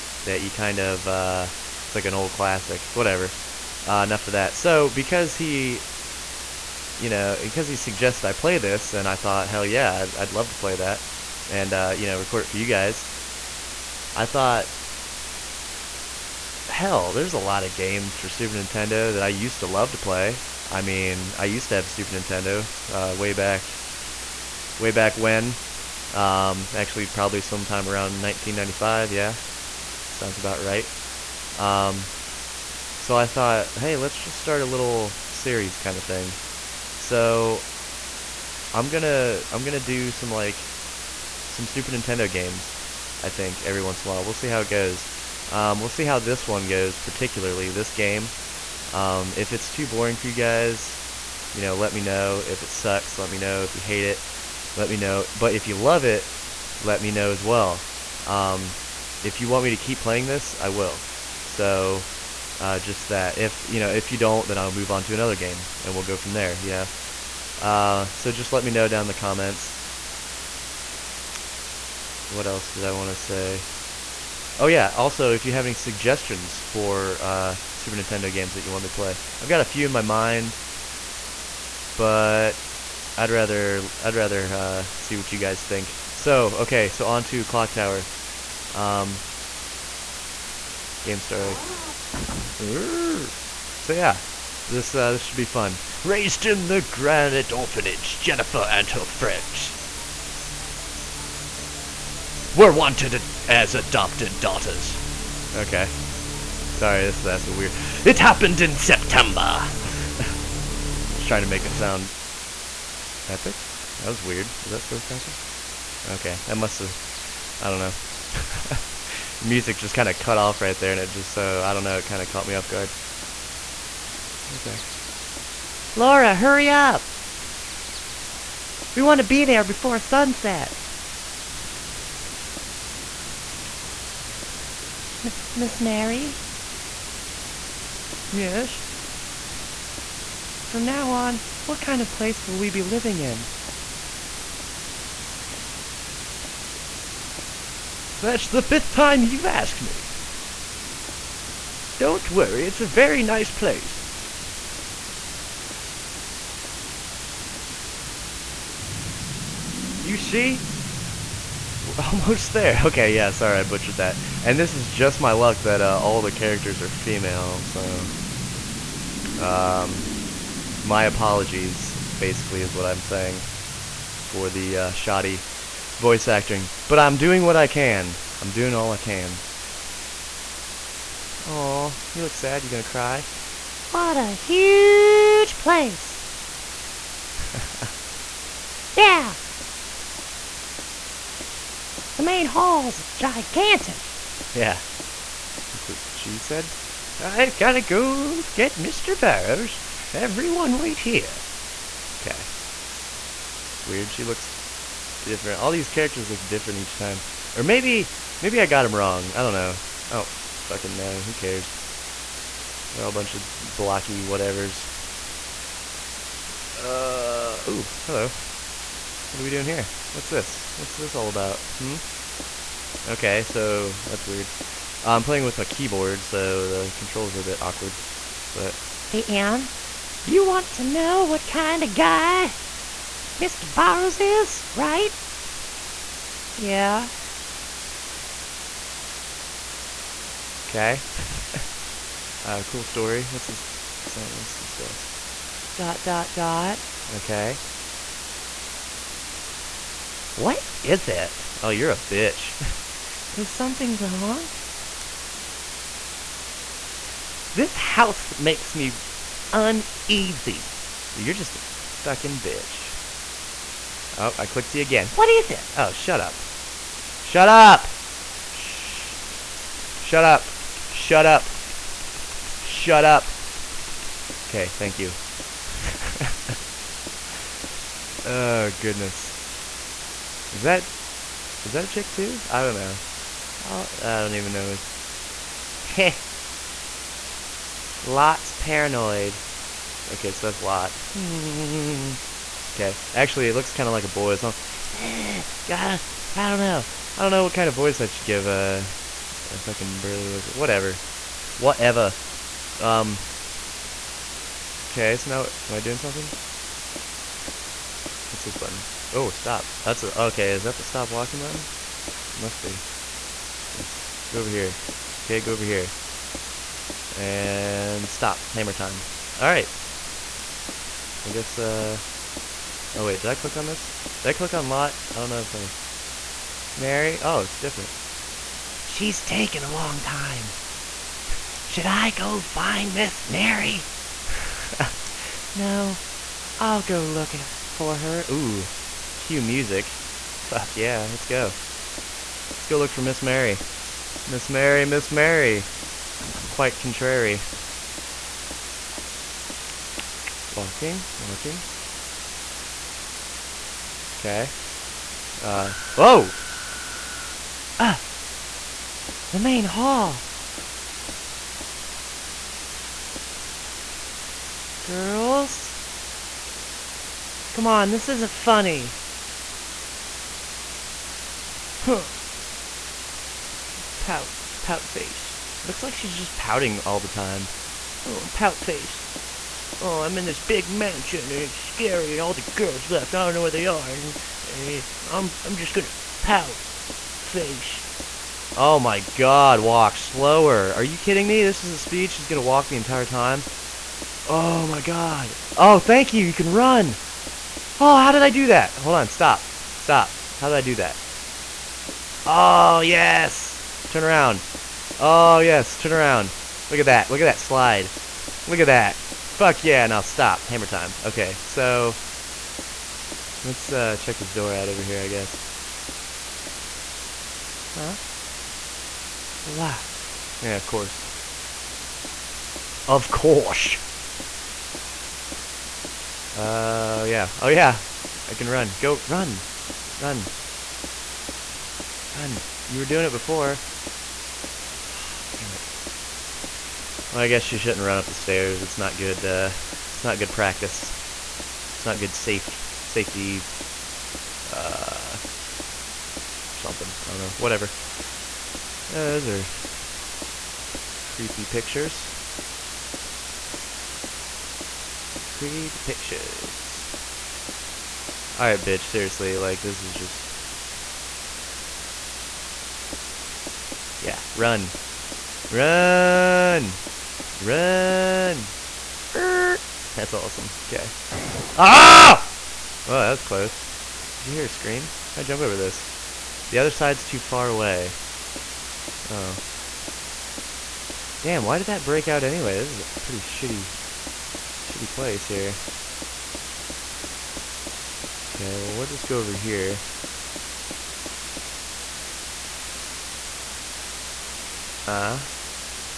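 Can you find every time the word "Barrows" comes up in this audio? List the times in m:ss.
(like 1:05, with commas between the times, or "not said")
3:19, 3:53.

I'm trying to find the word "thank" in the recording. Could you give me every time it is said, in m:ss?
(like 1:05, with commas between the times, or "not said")
4:34, 6:35.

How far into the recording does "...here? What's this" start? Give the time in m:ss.
3:39.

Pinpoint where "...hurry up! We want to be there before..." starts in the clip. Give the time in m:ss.
2:06.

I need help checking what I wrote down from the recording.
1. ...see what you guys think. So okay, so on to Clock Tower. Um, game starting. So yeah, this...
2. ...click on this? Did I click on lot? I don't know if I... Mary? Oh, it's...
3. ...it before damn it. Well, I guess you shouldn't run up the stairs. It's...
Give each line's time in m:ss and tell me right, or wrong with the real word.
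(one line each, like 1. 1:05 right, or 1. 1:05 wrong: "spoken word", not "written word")
1. 1:24 right
2. 5:23 right
3. 7:13 right.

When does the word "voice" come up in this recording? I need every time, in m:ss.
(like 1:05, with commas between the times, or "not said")
2:55, 4:57.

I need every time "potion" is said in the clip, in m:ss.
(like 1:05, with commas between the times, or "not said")
not said.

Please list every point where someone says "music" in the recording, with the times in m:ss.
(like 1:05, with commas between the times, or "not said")
1:59, 5:39.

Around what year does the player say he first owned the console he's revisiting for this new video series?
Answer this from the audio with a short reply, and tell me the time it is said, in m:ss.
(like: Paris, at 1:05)
1995, at 0:28.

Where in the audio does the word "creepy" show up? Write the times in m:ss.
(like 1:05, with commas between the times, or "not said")
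7:31, 7:35.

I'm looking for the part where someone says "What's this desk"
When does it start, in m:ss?
4:04.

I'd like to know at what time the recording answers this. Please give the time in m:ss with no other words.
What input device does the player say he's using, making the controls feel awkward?
3:45.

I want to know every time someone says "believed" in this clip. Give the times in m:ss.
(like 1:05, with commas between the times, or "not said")
not said.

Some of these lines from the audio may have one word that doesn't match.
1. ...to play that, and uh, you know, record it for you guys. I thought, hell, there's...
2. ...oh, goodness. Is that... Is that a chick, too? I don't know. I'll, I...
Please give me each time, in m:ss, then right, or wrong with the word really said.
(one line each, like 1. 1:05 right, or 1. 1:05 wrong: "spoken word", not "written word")
1. 0:10 right
2. 4:38 right.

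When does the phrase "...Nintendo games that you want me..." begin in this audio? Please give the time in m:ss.
1:17.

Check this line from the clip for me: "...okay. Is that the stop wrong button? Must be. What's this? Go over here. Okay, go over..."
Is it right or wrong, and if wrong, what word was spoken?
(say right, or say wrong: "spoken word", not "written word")
wrong: "walking", not "wrong".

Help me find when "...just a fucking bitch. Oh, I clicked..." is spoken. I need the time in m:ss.
4:21.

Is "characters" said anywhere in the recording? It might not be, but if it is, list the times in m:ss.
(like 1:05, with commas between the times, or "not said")
2:46, 3:25.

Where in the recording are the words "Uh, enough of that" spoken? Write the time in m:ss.
0:03.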